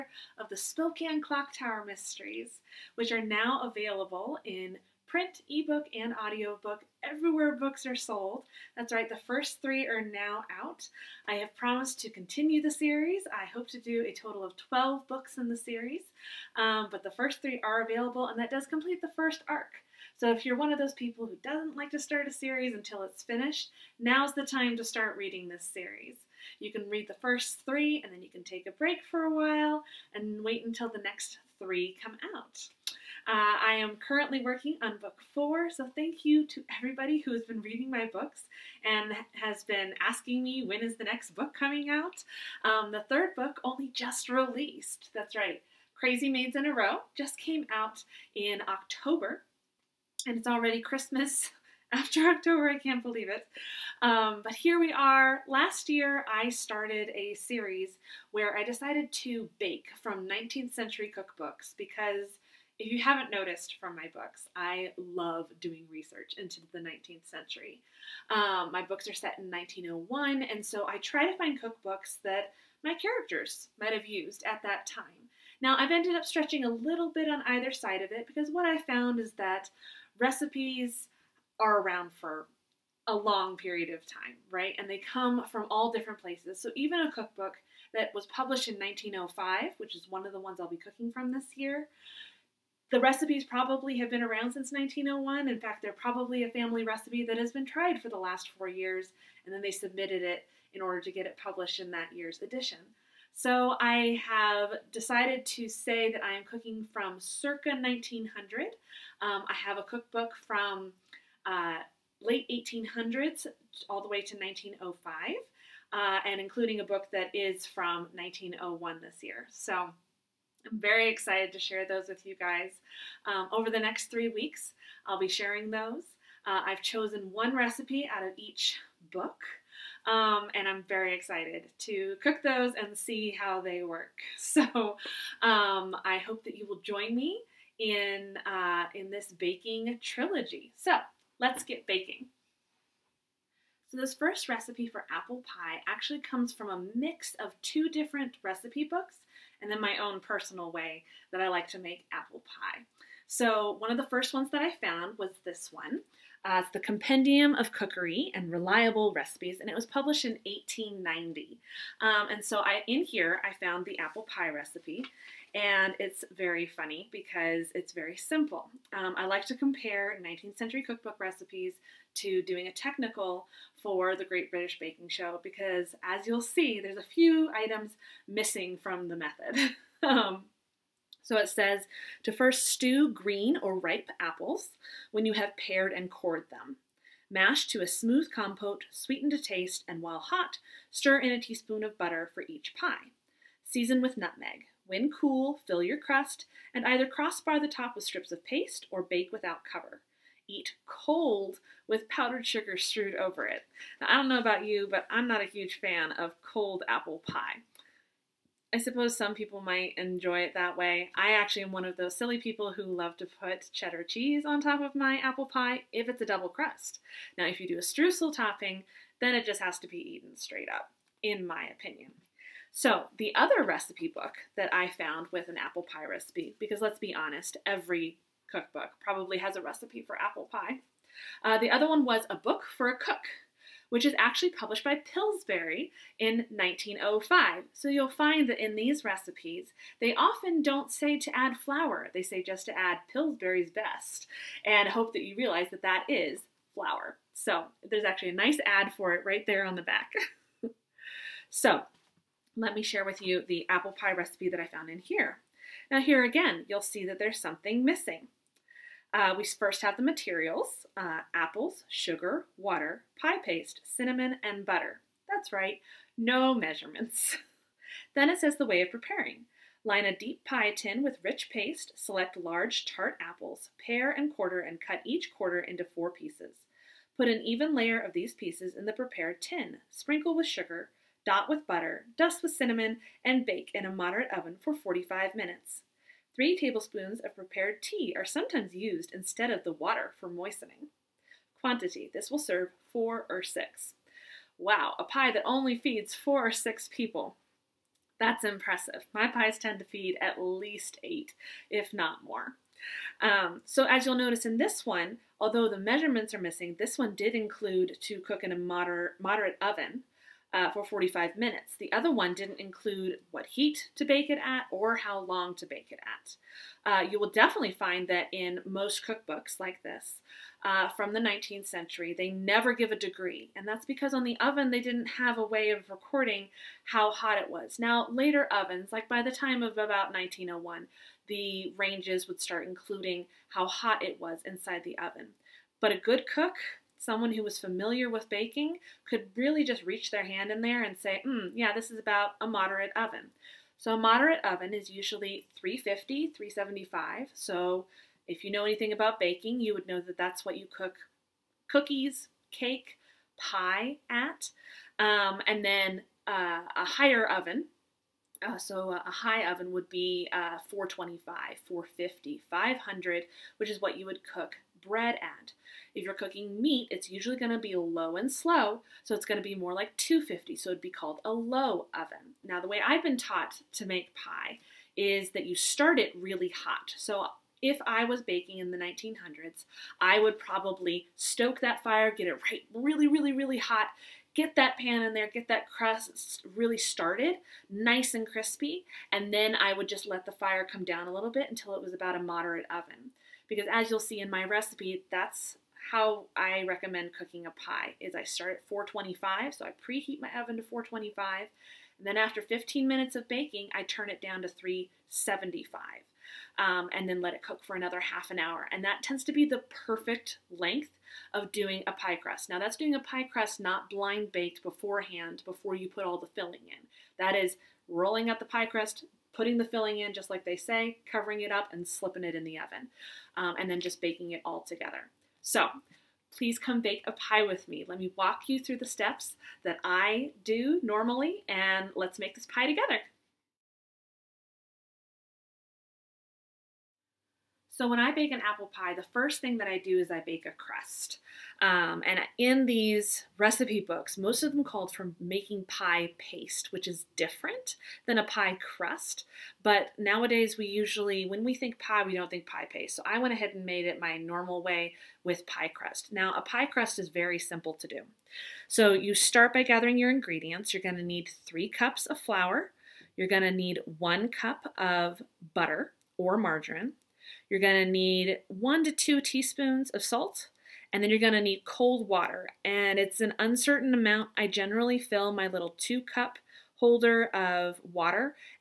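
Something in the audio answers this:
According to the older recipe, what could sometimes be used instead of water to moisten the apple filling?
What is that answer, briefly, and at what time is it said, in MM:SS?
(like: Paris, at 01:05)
Prepared tea, at 04:47.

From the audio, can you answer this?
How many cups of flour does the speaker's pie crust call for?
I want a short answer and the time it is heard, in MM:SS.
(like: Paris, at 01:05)
3, at 07:41.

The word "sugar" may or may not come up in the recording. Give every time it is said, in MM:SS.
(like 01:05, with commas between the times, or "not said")
03:22, 04:21, 04:40.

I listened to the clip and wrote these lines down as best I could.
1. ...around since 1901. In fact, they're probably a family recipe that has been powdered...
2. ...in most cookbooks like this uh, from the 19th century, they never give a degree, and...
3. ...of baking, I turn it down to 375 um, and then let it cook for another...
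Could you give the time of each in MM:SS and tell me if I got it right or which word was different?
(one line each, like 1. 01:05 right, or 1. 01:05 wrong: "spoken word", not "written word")
1. 01:34 wrong: "tried", not "powdered"
2. 05:18 right
3. 06:43 right.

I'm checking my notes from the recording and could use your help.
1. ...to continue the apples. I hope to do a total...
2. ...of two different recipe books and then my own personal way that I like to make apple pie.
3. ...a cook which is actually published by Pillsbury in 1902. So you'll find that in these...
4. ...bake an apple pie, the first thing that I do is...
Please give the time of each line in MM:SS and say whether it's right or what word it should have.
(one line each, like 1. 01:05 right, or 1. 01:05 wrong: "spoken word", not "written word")
1. 00:11 wrong: "series", not "apples"
2. 02:27 right
3. 03:52 wrong: "1905", not "1902"
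4. 07:18 right.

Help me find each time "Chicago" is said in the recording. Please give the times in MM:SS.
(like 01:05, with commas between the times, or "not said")
not said.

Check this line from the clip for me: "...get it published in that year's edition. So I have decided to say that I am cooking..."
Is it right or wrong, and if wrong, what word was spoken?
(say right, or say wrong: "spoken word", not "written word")
right.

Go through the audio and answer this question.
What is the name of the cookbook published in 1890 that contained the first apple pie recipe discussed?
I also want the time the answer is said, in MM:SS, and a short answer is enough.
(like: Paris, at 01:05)
Compendium of Cookery and Reliable Recipes, at 02:36.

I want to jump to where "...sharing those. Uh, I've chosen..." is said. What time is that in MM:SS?
02:05.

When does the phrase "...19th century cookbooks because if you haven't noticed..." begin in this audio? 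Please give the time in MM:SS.
01:00.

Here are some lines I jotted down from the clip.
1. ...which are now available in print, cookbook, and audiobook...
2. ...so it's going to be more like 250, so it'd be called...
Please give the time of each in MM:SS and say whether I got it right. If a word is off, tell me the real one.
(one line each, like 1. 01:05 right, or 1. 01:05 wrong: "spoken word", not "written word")
1. 00:02 wrong: "ebook", not "cookbook"
2. 06:09 right.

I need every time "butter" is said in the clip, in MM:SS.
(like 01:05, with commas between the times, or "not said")
03:11, 04:24, 04:41, 07:45.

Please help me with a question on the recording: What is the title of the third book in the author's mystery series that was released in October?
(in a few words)
Crazy Maids in a Row.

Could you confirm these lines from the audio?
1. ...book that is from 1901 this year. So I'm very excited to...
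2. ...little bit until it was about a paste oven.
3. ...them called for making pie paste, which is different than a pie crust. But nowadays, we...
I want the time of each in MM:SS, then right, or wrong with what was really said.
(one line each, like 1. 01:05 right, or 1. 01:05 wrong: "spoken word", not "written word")
1. 01:56 right
2. 06:31 wrong: "moderate", not "paste"
3. 07:24 right.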